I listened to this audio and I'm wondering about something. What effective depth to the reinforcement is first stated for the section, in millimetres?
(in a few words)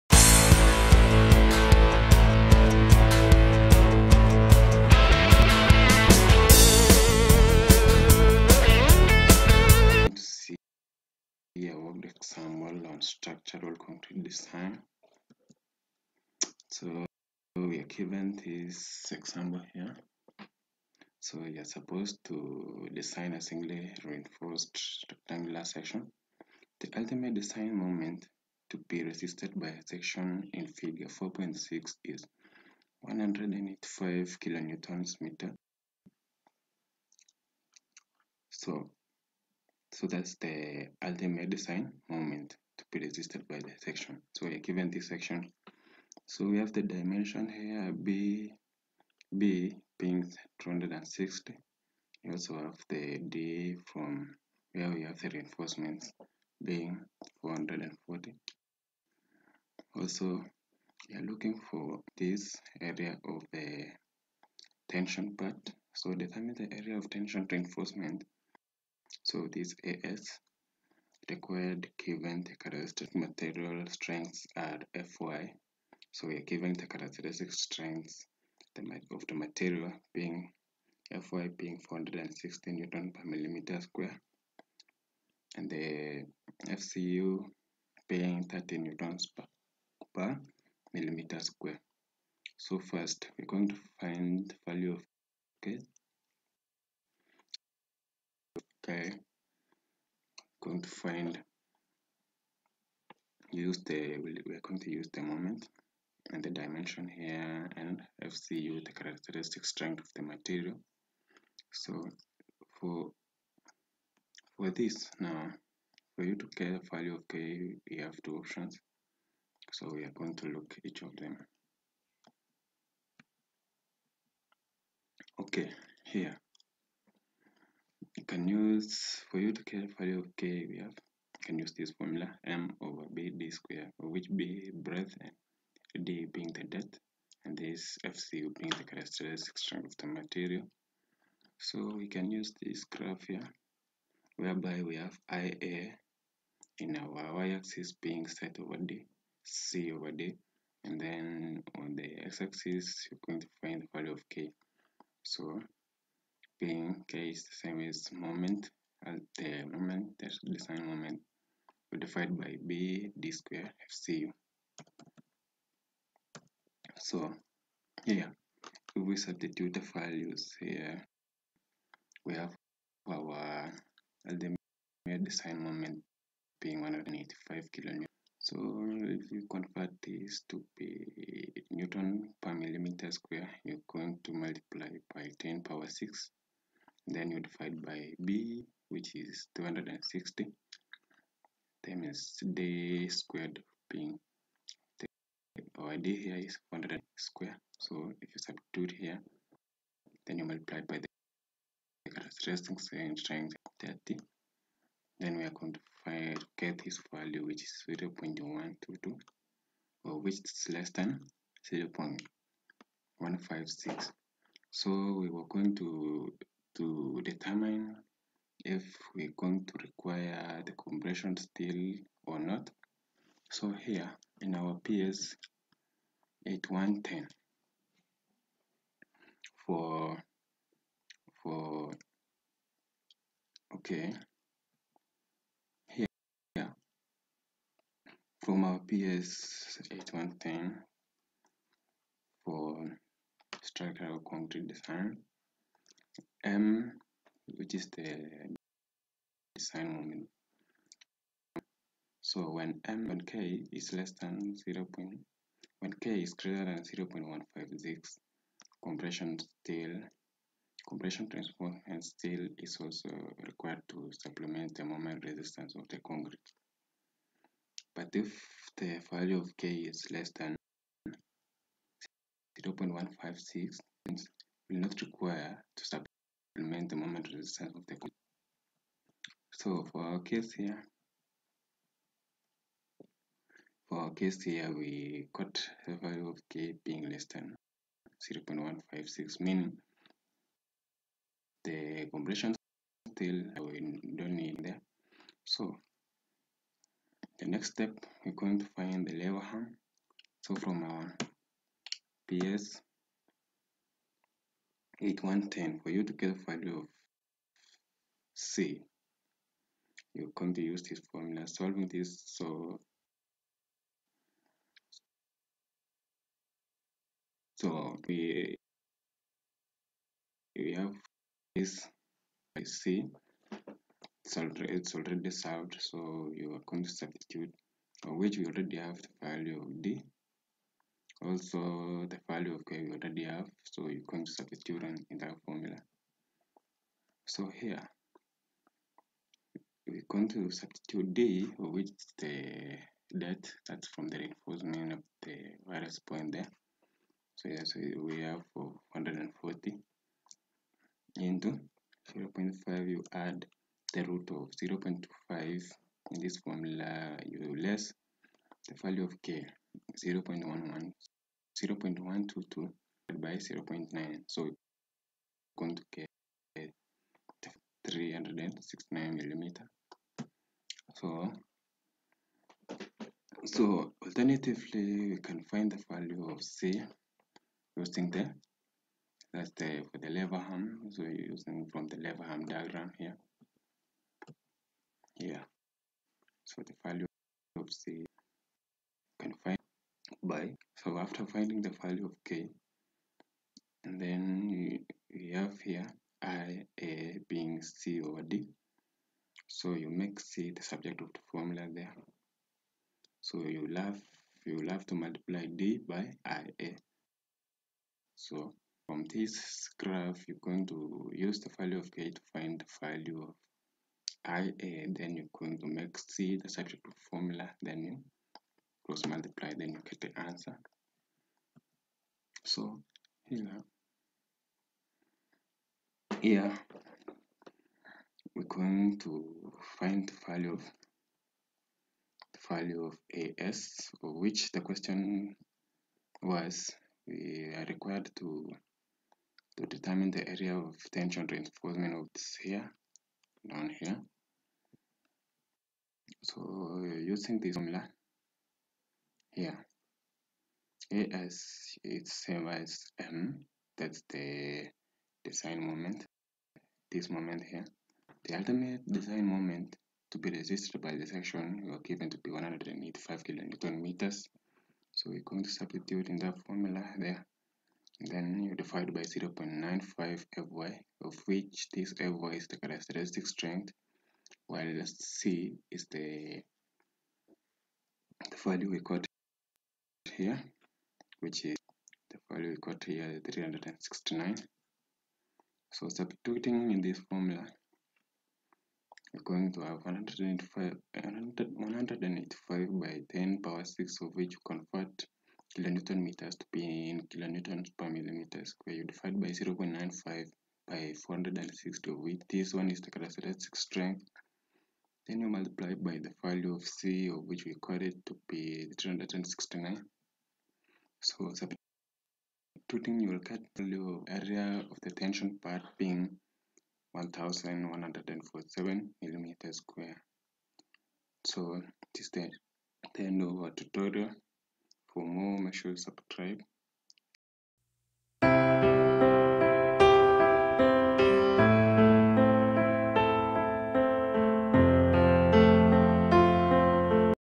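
440.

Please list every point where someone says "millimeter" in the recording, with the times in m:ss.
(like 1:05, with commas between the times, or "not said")
1:23, 1:30, 3:02, 6:09, 8:17, 8:39.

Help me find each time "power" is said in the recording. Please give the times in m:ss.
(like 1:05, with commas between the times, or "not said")
3:05, 8:13.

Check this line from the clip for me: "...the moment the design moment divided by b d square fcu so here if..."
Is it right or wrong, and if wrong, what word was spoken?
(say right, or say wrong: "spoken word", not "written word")
right.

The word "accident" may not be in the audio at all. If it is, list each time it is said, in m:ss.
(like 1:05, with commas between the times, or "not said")
not said.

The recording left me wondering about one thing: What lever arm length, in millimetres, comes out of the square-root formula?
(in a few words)
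369 mm.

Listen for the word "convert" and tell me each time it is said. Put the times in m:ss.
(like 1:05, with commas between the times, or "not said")
2:59, 8:14.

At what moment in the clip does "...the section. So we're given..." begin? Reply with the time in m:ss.
0:43.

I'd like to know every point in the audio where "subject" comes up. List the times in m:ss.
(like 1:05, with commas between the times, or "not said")
6:40, 6:56.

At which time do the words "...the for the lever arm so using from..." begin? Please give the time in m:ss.
6:19.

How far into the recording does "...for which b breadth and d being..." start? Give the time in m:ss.
2:13.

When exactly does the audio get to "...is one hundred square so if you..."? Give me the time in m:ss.
3:16.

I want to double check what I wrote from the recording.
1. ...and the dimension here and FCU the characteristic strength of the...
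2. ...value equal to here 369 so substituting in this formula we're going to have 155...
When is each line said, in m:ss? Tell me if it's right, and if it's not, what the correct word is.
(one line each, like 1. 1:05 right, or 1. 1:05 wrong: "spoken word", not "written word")
1. 1:46 right
2. 8:02 wrong: "185", not "155".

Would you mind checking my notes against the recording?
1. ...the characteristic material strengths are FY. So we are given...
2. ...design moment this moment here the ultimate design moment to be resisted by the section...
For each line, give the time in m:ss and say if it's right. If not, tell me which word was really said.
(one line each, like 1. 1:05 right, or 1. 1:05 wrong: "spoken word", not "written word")
1. 1:12 right
2. 7:35 right.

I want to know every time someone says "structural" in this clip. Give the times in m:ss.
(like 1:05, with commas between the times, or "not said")
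0:13, 4:03.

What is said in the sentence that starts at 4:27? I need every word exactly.
But if the value of K is less than 0 0.156, will not require to supplement the moment resistance of the coil.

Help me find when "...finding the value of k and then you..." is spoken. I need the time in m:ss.
6:31.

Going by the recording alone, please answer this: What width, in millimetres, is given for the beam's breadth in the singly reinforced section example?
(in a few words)
260.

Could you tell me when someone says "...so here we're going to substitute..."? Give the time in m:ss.
5:37.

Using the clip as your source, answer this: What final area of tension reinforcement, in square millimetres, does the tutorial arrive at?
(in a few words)
1147.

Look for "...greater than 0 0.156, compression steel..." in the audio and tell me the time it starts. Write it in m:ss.
4:16.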